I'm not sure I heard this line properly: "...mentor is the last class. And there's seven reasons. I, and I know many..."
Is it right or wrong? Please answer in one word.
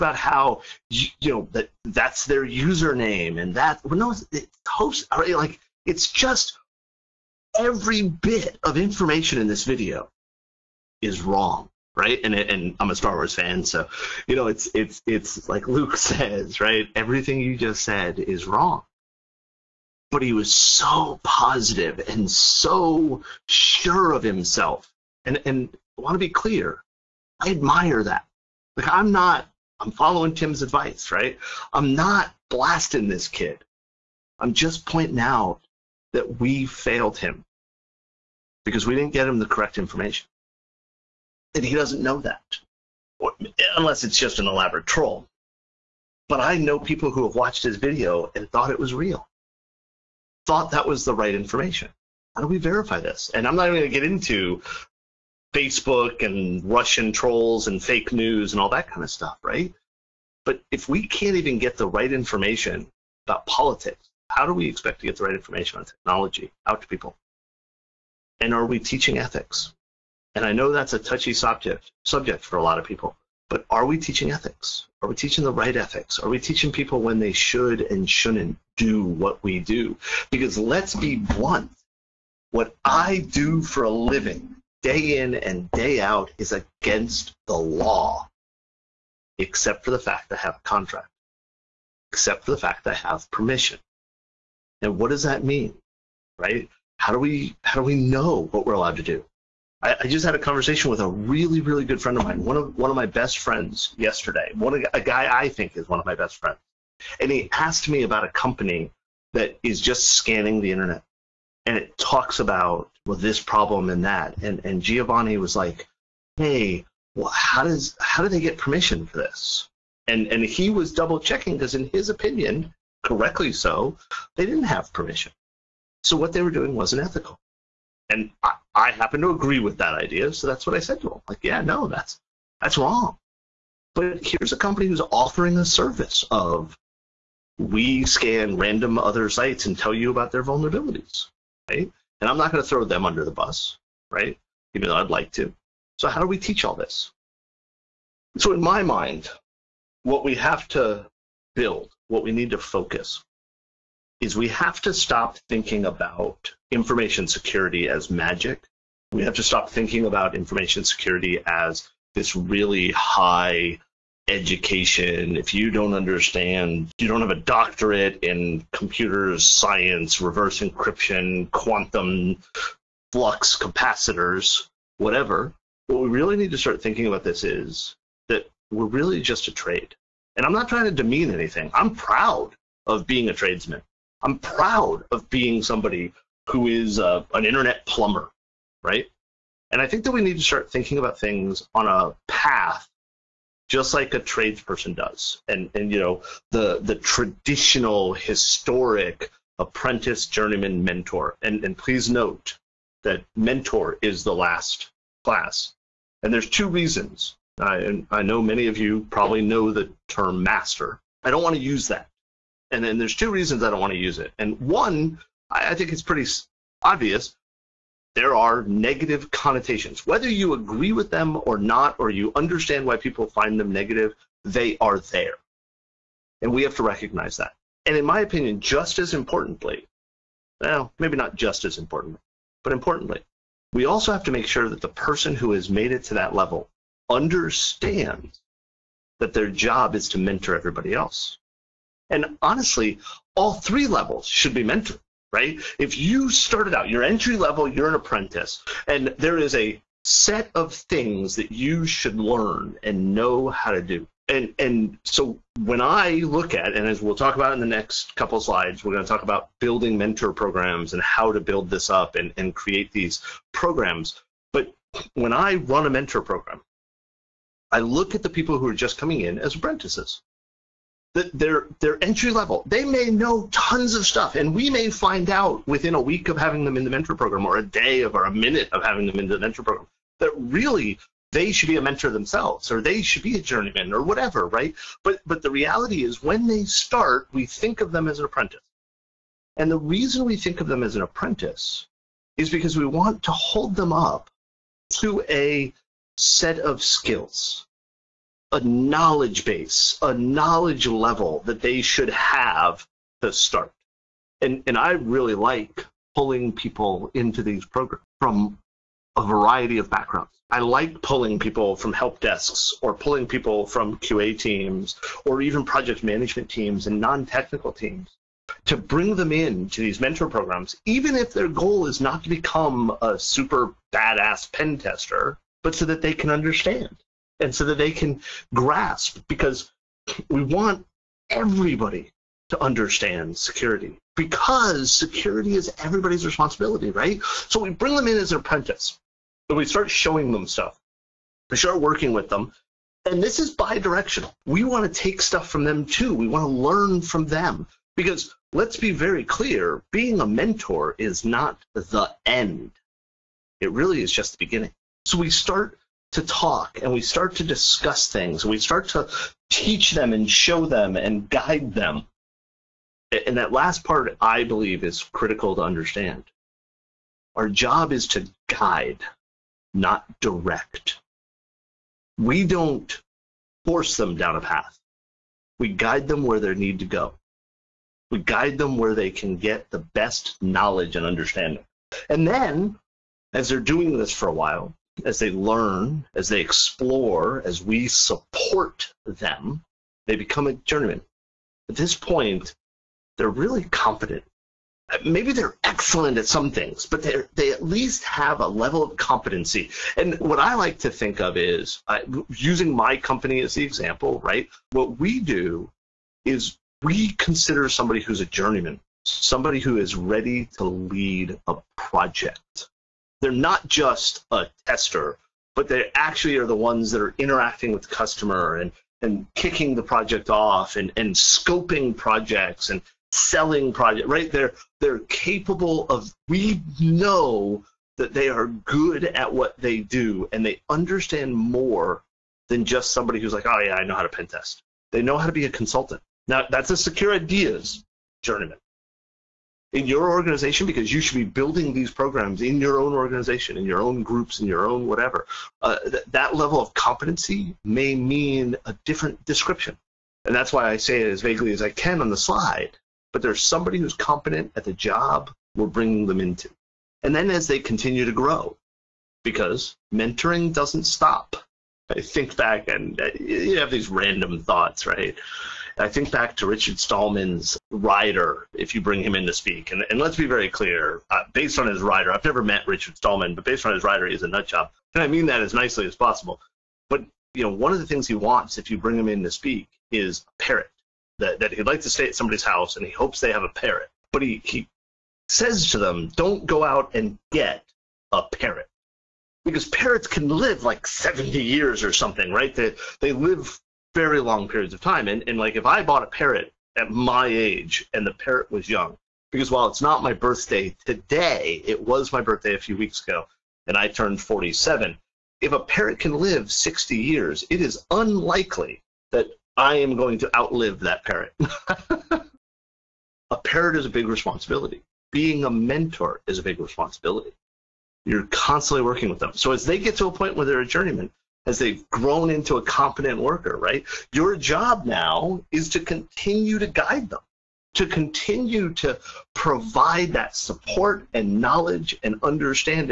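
wrong.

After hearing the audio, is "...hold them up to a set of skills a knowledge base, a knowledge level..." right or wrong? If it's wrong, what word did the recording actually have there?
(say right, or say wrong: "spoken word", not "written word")
right.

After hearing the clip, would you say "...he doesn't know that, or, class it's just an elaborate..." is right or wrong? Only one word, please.
wrong.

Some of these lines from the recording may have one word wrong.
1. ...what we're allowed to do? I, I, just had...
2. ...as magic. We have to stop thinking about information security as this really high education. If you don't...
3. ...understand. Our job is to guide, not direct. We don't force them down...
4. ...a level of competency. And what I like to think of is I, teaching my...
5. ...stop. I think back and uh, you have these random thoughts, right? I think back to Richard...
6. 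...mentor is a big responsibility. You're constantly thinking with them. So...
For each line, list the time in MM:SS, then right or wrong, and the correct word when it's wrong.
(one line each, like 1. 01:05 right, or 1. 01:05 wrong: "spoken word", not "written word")
1. 01:38 right
2. 02:37 right
3. 06:05 right
4. 06:38 wrong: "using", not "teaching"
5. 07:40 right
6. 08:35 wrong: "working", not "thinking".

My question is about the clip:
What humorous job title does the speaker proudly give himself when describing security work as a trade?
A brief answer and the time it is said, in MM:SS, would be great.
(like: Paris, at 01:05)
internet plumber, at 03:07.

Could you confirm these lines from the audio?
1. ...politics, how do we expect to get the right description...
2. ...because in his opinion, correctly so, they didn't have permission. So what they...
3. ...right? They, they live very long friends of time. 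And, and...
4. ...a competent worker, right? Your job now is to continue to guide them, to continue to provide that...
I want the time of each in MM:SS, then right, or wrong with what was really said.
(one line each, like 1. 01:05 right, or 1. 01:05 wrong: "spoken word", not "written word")
1. 01:03 wrong: "information", not "description"
2. 02:01 right
3. 08:12 wrong: "periods", not "friends"
4. 08:42 right.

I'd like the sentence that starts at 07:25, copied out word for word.
Uh, th- that level of competency may mean a different description.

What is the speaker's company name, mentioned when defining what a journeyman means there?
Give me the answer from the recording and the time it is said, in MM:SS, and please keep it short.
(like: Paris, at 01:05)
Secure Ideas, at 07:16.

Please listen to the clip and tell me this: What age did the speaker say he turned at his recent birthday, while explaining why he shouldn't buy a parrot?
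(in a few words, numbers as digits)
47.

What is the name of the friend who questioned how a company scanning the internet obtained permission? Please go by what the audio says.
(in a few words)
Giovanni.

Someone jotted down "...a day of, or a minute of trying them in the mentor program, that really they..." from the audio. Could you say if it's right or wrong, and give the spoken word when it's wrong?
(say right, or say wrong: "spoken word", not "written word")
wrong: "having", not "trying".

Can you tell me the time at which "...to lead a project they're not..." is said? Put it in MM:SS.
06:50.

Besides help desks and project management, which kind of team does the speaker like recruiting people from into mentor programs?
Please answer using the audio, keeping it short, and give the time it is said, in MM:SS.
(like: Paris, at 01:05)
QA teams, at 05:13.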